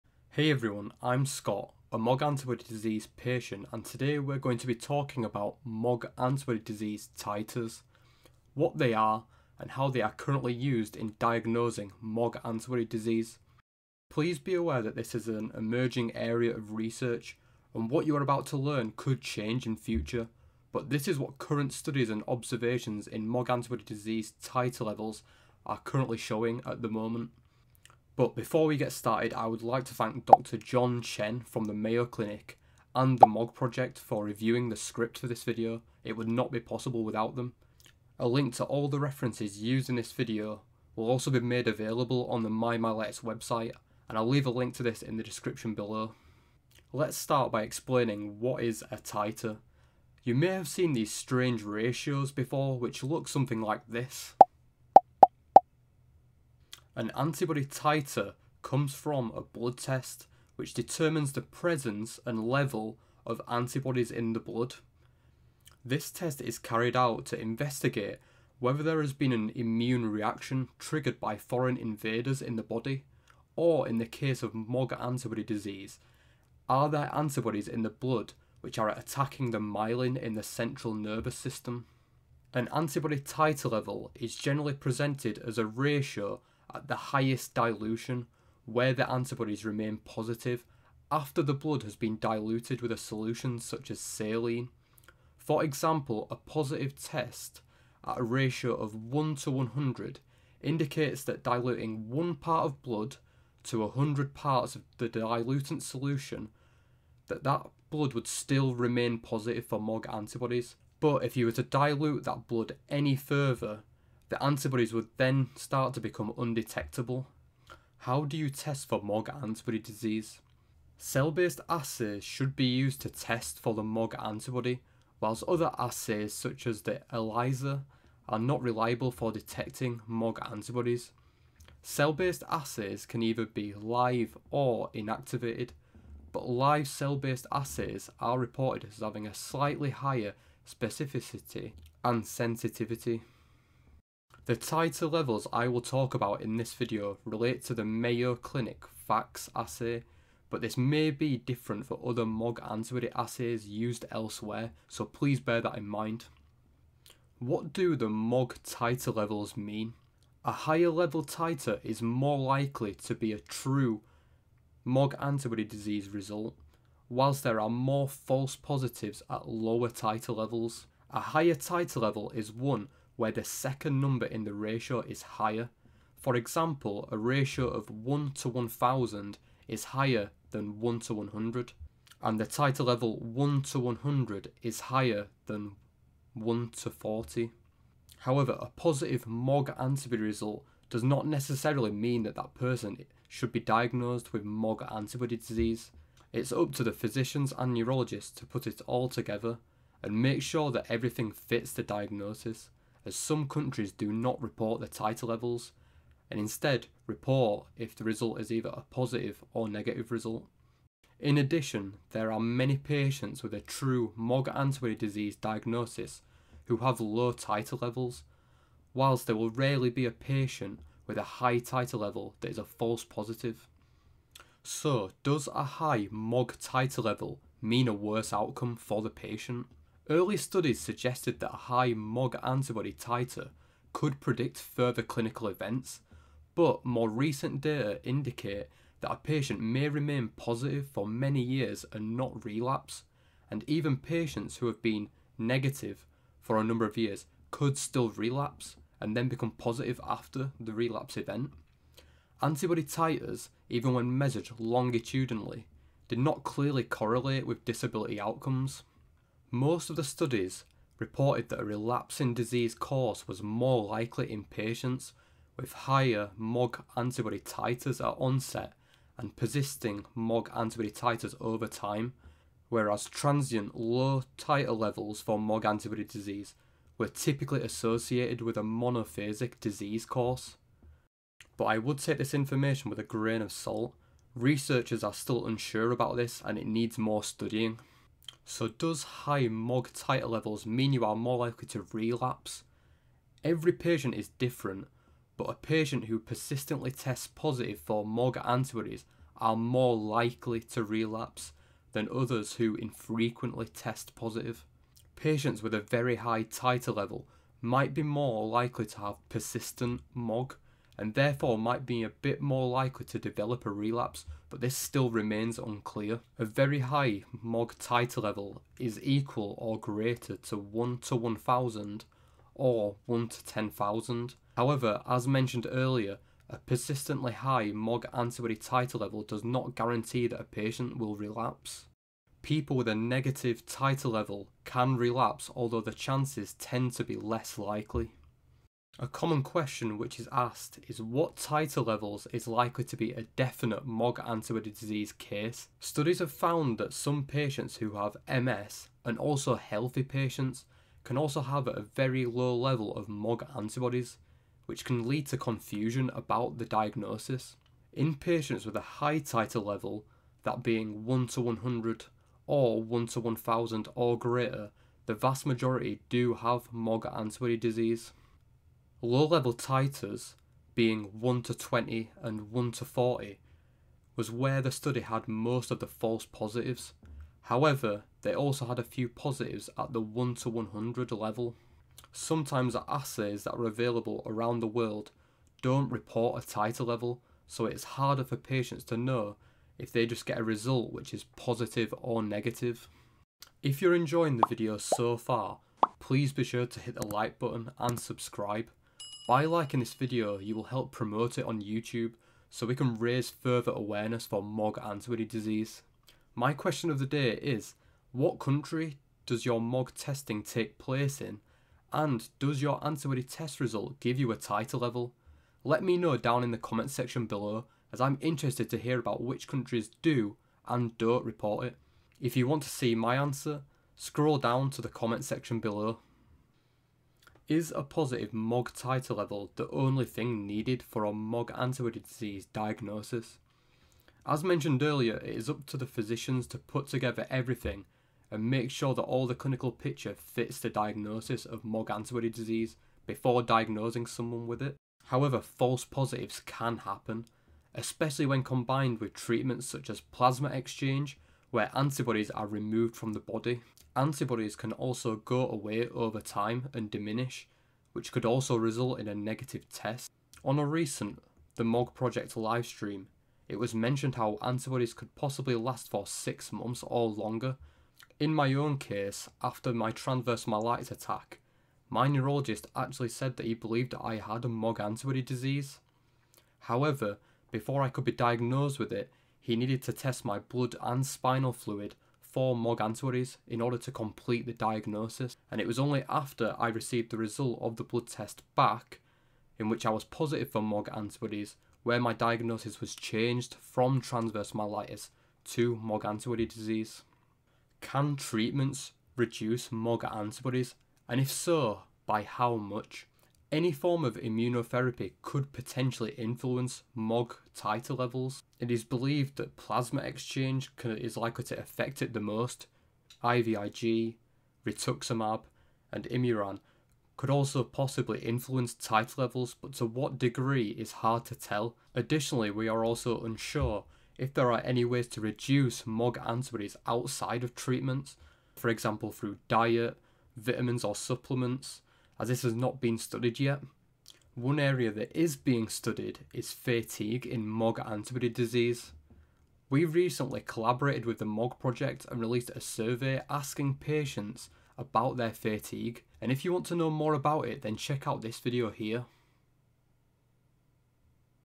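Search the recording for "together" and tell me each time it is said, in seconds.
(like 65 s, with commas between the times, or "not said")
199 s, 436 s.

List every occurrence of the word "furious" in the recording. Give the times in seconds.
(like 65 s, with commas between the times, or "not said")
not said.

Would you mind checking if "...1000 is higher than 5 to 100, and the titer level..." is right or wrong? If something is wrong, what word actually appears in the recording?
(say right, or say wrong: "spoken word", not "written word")
wrong: "1", not "5".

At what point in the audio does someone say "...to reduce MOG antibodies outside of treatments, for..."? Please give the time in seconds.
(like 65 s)
525 s.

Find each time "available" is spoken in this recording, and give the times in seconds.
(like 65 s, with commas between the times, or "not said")
41 s, 383 s.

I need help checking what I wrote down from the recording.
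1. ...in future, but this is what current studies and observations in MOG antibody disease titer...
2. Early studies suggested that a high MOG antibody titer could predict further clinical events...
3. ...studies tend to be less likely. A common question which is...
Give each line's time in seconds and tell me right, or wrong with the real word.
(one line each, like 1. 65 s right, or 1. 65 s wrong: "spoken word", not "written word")
1. 19 s right
2. 230 s right
3. 335 s wrong: "chances", not "studies".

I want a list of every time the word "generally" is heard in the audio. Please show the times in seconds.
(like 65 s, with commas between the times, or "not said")
84 s.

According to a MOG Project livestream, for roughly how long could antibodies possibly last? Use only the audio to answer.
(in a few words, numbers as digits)
6 months.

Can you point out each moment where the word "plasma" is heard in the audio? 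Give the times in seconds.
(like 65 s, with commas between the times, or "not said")
449 s, 509 s.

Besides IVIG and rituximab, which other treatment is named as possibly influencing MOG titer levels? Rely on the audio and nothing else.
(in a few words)
Imuran.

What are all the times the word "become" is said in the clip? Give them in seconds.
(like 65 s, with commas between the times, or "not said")
115 s, 249 s.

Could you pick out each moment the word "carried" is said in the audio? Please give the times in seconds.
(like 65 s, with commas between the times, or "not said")
66 s.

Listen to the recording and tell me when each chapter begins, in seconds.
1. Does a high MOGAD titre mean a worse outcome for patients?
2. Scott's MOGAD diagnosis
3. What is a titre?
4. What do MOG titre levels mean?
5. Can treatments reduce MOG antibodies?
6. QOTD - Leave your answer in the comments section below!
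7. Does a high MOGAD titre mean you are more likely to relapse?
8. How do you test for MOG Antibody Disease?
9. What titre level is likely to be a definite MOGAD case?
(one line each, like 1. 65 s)
1. 224 s
2. 468 s
3. 47 s
4. 157 s
5. 498 s
6. 393 s
7. 288 s
8. 118 s
9. 341 s.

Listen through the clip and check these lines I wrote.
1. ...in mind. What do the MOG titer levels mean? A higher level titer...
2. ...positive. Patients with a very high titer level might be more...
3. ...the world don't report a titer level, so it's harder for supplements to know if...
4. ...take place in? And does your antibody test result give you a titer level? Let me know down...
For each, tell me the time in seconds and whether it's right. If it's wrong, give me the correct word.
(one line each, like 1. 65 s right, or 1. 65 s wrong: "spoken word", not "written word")
1. 155 s right
2. 304 s right
3. 384 s wrong: "patients", not "supplements"
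4. 410 s right.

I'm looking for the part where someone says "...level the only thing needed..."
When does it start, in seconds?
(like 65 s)
429 s.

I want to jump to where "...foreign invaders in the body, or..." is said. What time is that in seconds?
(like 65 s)
71 s.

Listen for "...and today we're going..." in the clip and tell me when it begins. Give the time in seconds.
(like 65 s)
3 s.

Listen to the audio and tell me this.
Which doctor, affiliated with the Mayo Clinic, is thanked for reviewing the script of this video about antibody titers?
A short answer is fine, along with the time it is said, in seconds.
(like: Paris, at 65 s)
John Chen, at 30 s.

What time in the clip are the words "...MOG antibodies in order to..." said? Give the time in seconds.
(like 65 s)
482 s.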